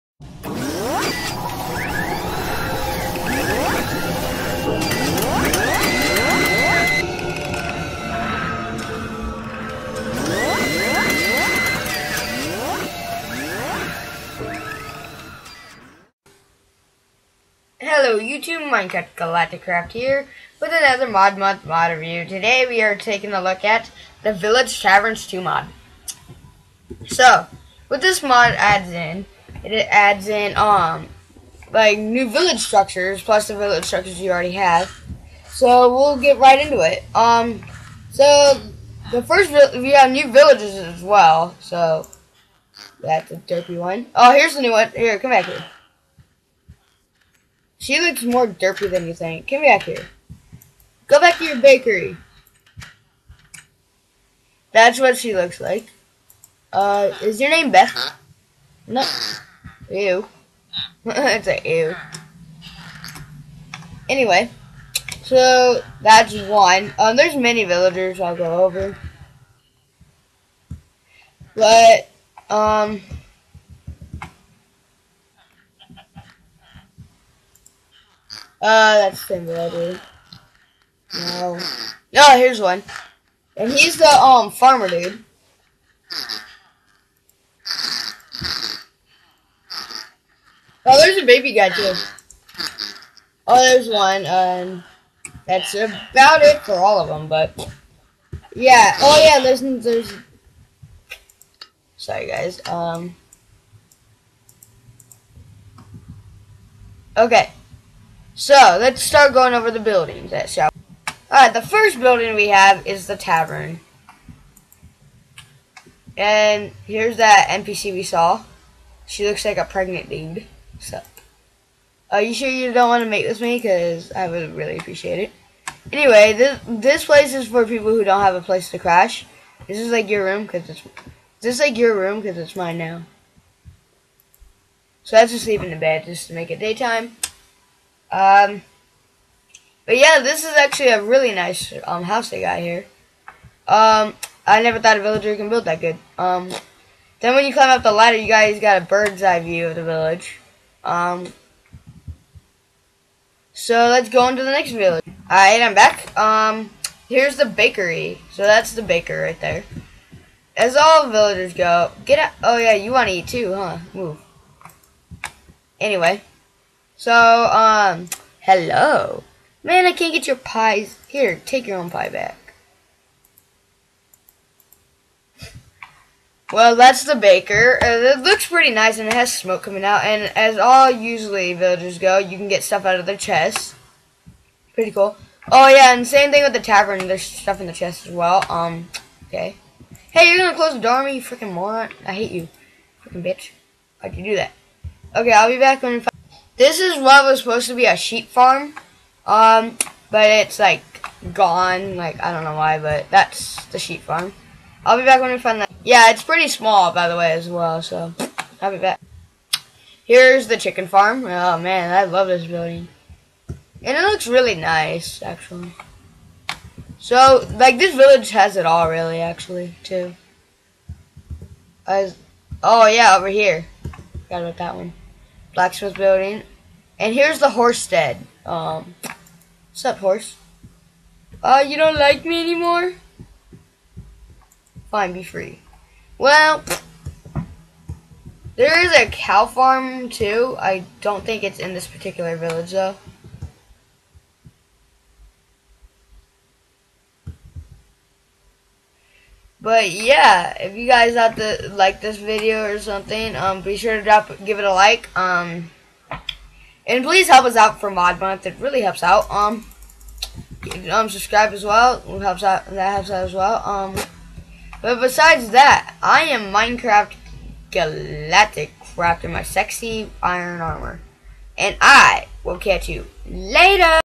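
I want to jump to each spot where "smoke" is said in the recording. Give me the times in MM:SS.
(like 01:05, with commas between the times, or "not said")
02:59.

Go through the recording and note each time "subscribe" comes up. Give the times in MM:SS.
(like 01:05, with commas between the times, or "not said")
04:21.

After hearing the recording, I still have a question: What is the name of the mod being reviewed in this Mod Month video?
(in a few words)
Village Taverns 2.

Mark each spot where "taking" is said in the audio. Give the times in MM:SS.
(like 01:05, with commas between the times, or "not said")
00:22.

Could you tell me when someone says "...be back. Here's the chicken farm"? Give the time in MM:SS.
03:28.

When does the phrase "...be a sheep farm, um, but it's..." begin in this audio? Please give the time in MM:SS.
03:17.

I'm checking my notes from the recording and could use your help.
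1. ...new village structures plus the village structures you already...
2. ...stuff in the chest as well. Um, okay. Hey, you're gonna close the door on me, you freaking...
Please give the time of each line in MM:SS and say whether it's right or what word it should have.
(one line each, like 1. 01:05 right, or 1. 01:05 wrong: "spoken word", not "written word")
1. 00:31 right
2. 03:07 right.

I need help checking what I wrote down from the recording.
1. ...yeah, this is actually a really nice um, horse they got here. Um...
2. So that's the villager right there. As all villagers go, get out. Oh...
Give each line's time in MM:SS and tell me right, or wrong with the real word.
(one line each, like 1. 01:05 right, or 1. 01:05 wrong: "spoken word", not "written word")
1. 02:19 wrong: "house", not "horse"
2. 02:38 wrong: "baker", not "villager".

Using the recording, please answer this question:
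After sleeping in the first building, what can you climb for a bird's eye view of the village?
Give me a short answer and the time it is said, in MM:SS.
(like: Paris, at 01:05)
ladder, at 02:27.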